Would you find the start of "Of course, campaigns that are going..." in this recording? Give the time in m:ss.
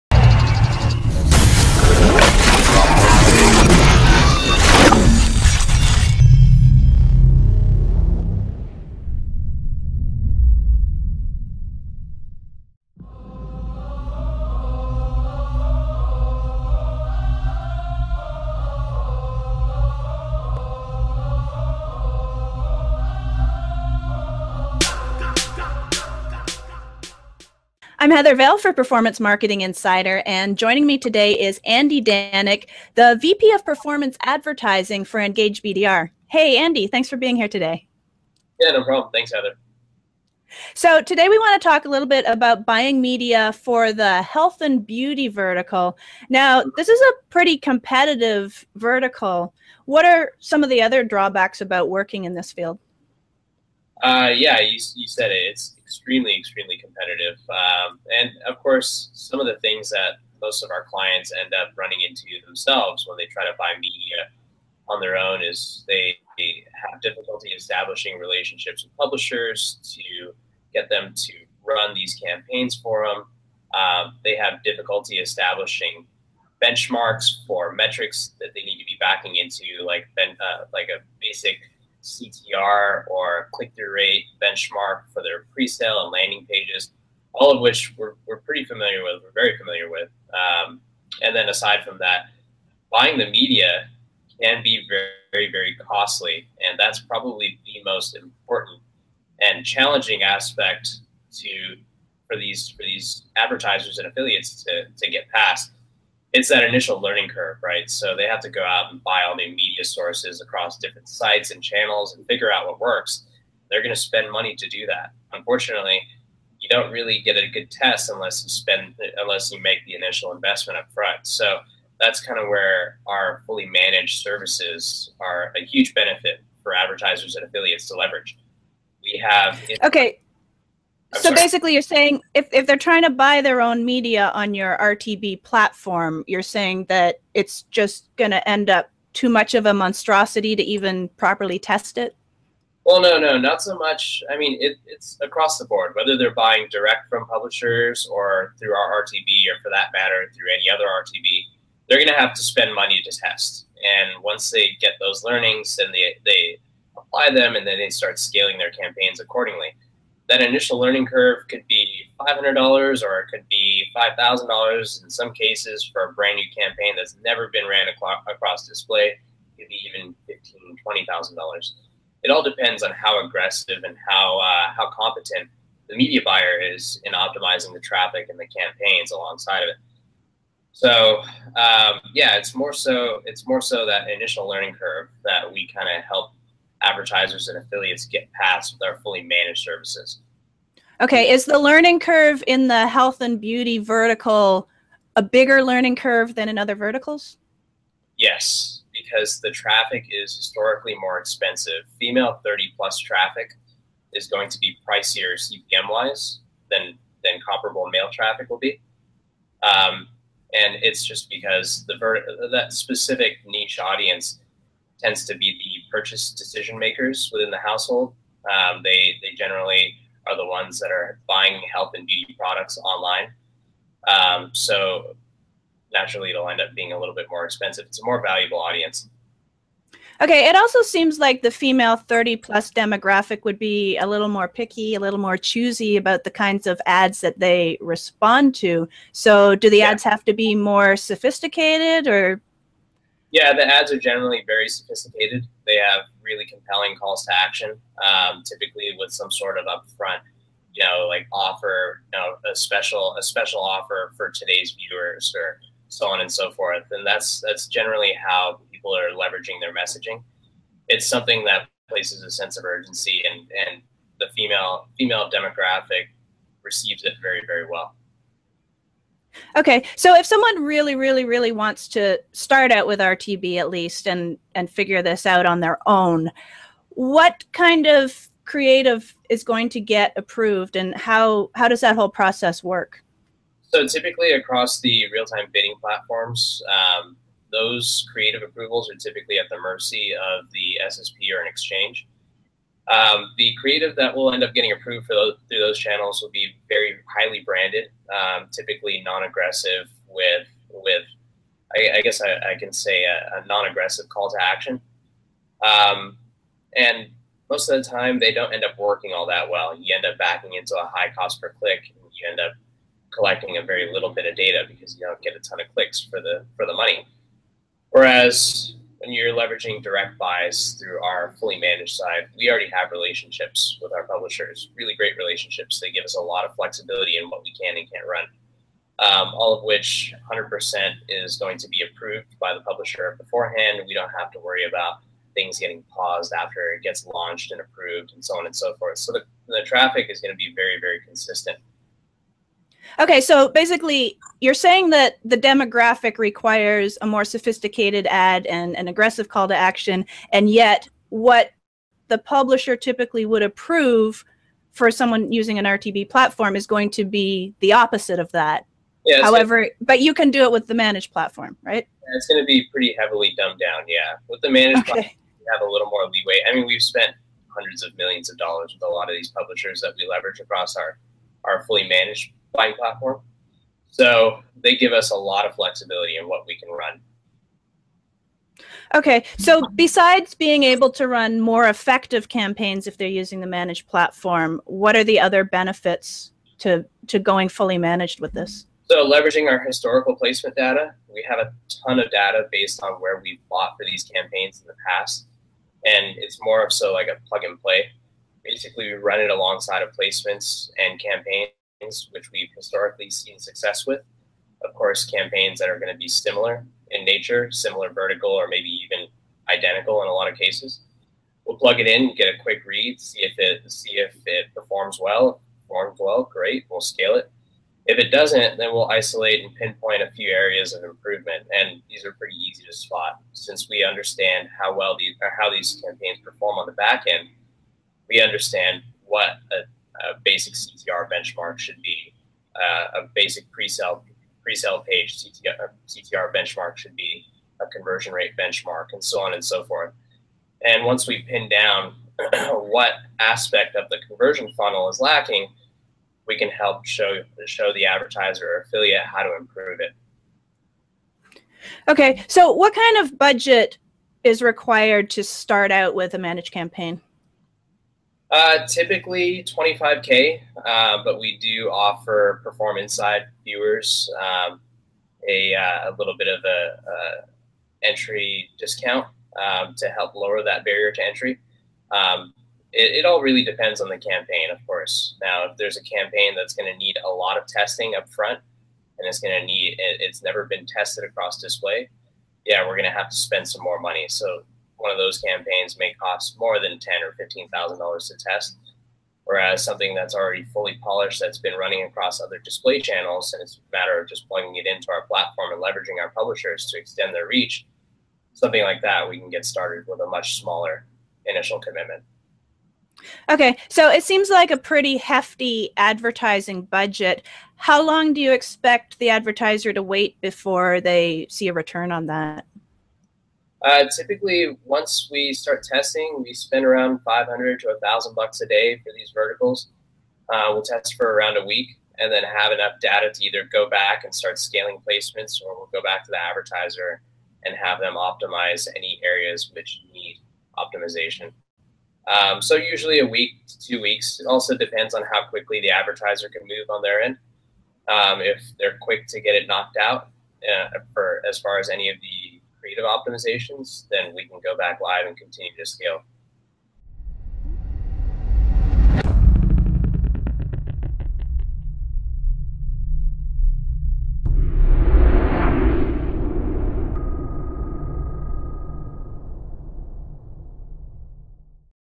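6:44.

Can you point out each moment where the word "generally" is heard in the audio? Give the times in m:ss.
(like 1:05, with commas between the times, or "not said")
3:39, 4:03, 4:17.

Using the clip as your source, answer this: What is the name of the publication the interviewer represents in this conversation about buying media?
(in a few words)
Performance Marketing Insider.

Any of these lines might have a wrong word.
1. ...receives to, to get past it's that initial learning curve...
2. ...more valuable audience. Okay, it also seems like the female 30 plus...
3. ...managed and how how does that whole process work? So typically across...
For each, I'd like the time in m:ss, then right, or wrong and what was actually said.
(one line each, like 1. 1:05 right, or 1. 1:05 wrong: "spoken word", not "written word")
1. 1:44 wrong: "affiliates", not "receives"
2. 3:48 right
3. 4:40 wrong: "approved", not "managed".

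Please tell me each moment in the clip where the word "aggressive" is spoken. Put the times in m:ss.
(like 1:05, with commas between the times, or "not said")
2:53, 4:59, 5:03, 5:48.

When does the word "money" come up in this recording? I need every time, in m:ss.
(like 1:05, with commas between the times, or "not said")
1:54, 2:32, 5:16, 8:03.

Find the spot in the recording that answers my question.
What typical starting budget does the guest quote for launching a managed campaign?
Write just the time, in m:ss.
7:39.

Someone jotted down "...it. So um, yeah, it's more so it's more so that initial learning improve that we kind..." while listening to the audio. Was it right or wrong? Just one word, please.
wrong.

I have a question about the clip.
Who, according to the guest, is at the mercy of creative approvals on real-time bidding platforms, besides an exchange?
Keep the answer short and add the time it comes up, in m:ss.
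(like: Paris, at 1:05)
the SSP, at 4:50.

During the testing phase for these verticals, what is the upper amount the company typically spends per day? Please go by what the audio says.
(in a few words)
1,000 dollars.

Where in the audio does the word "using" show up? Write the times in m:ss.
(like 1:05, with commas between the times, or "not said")
5:55, 6:23.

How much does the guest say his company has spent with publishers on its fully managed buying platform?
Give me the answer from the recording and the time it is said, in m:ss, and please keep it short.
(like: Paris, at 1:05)
hundreds of millions of dollars, at 6:07.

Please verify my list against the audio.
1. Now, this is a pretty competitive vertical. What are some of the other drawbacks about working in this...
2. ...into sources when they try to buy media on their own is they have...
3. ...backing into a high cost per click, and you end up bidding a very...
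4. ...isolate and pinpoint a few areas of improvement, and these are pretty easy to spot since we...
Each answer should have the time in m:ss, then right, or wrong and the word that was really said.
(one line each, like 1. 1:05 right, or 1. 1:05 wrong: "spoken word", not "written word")
1. 0:46 right
2. 1:02 wrong: "themselves", not "sources"
3. 5:10 wrong: "collecting", not "bidding"
4. 6:58 right.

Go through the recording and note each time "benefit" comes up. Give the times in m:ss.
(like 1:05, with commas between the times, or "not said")
2:05, 6:25.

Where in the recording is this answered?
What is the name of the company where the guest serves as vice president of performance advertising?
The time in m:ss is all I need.
0:35.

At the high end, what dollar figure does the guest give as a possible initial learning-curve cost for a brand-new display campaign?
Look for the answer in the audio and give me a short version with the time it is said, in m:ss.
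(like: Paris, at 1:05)
$20,000, at 2:51.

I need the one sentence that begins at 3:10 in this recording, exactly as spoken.
Okay, is the learning curve in the health and beauty vertical a bigger learning curve than in other verticals?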